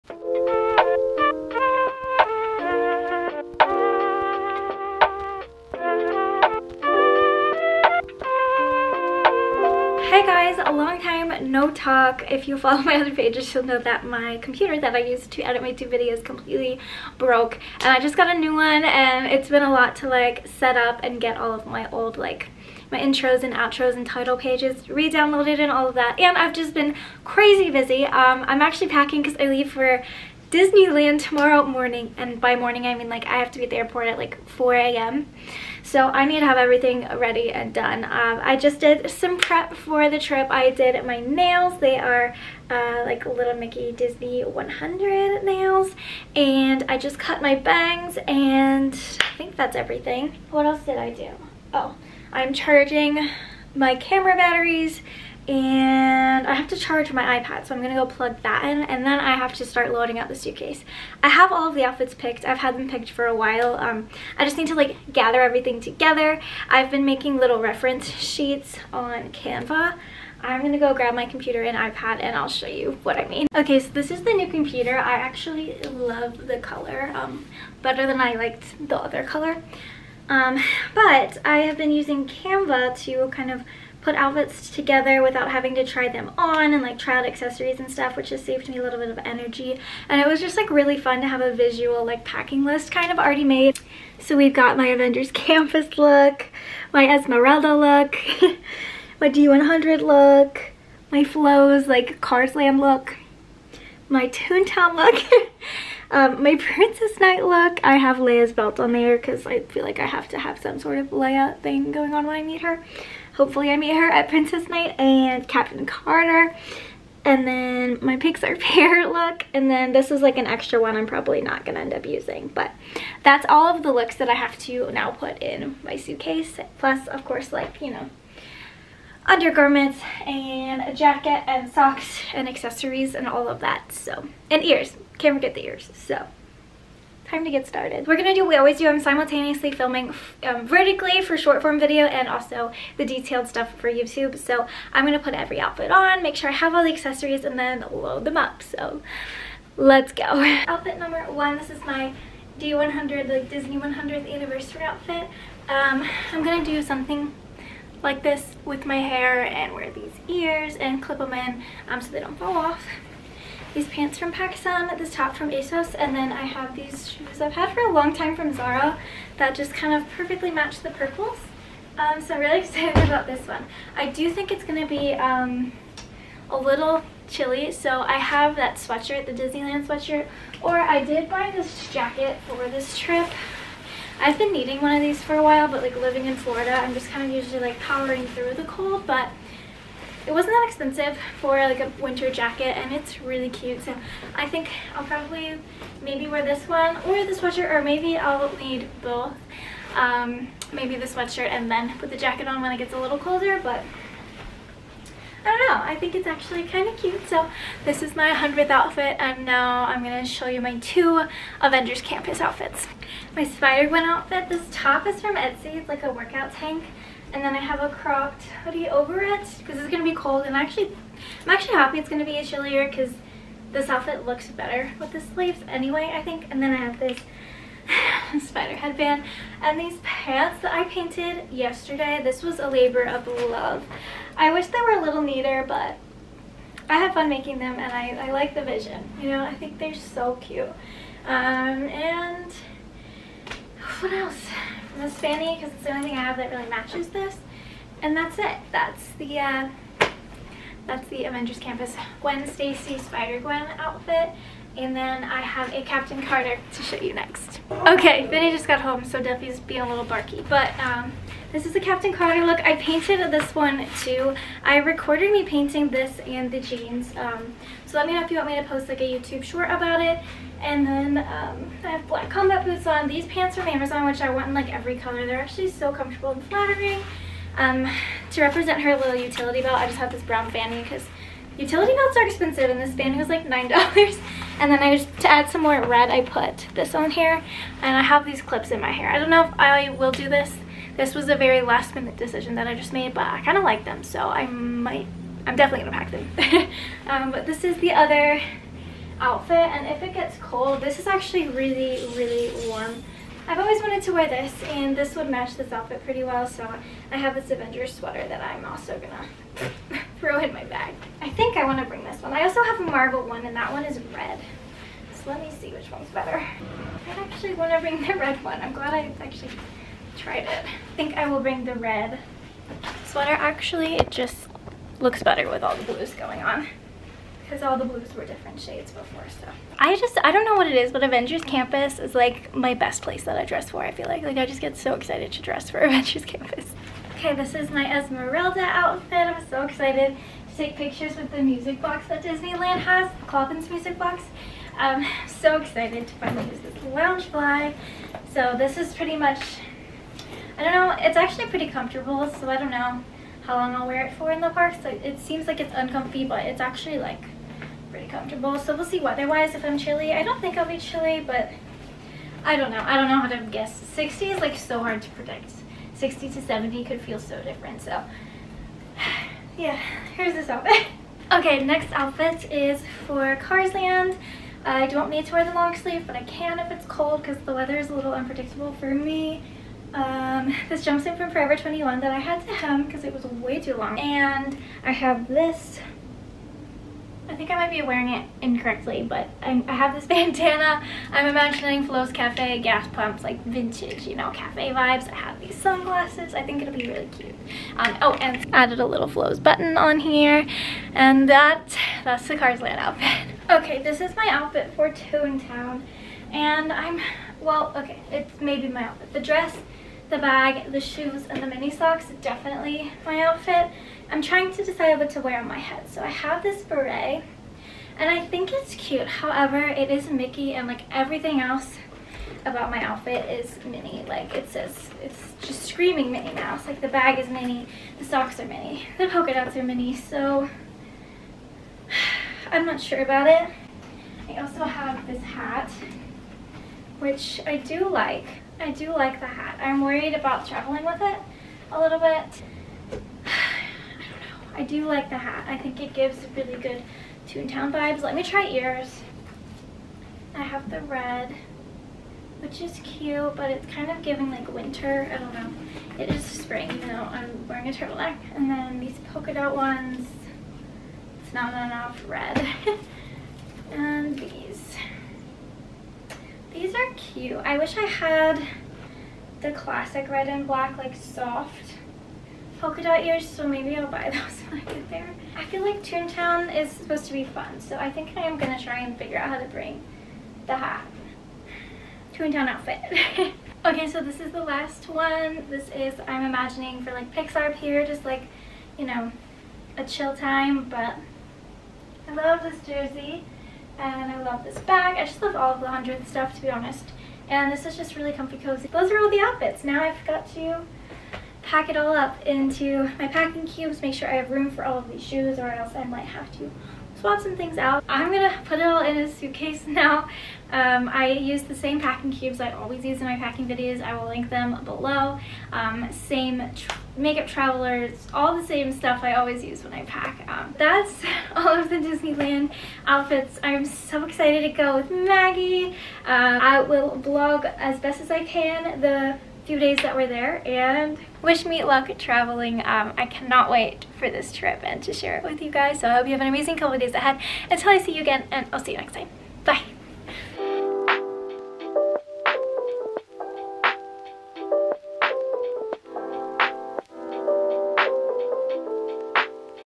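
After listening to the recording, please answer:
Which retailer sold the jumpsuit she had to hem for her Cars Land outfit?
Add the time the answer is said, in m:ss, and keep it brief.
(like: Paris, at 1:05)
Forever 21, at 6:21.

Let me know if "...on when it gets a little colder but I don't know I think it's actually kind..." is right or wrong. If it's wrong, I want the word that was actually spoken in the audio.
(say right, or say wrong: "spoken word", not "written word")
right.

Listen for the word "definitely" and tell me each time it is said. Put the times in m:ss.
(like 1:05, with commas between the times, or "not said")
4:55, 6:52.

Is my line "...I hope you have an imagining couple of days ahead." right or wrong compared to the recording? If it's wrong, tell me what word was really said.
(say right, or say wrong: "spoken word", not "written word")
wrong: "amazing", not "imagining".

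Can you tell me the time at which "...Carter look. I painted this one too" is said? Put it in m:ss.
4:22.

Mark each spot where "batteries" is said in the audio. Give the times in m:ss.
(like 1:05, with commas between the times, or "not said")
0:54.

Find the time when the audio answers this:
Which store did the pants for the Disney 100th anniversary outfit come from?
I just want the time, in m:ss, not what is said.
2:44.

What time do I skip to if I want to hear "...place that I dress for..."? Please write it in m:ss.
5:33.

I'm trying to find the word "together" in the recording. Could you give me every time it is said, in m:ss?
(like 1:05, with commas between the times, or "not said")
1:05, 1:24.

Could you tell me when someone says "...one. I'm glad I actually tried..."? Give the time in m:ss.
5:18.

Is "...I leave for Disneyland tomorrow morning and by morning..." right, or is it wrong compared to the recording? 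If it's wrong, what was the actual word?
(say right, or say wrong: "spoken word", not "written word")
right.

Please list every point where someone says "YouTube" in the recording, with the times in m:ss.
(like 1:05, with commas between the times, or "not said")
2:23, 4:29.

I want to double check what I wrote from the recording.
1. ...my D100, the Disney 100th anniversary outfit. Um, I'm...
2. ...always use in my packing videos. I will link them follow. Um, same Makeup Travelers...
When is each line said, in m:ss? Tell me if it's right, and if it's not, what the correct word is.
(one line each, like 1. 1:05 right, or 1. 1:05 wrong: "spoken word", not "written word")
1. 2:31 right
2. 8:32 wrong: "below", not "follow".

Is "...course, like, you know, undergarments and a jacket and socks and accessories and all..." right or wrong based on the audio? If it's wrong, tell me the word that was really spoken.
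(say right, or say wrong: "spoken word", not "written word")
right.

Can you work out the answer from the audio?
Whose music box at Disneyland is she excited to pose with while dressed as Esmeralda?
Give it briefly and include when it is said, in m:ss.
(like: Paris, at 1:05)
Clopin, at 5:43.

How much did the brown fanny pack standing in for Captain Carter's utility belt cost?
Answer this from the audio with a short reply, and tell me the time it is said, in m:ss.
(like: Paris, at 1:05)
$9, at 4:43.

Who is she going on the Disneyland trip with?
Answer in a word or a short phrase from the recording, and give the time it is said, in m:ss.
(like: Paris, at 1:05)
Maggie, at 8:44.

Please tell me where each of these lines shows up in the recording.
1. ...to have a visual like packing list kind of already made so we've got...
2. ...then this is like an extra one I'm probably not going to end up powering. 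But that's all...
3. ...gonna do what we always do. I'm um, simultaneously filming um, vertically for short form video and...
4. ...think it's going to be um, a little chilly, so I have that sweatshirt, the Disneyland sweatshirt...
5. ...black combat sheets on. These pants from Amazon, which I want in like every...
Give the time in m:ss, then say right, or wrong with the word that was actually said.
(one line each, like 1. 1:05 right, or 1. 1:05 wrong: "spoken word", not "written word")
1. 1:31 right
2. 1:59 wrong: "using", not "powering"
3. 2:18 right
4. 2:54 right
5. 4:32 wrong: "boots", not "sheets".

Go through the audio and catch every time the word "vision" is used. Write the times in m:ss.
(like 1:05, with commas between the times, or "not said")
3:58.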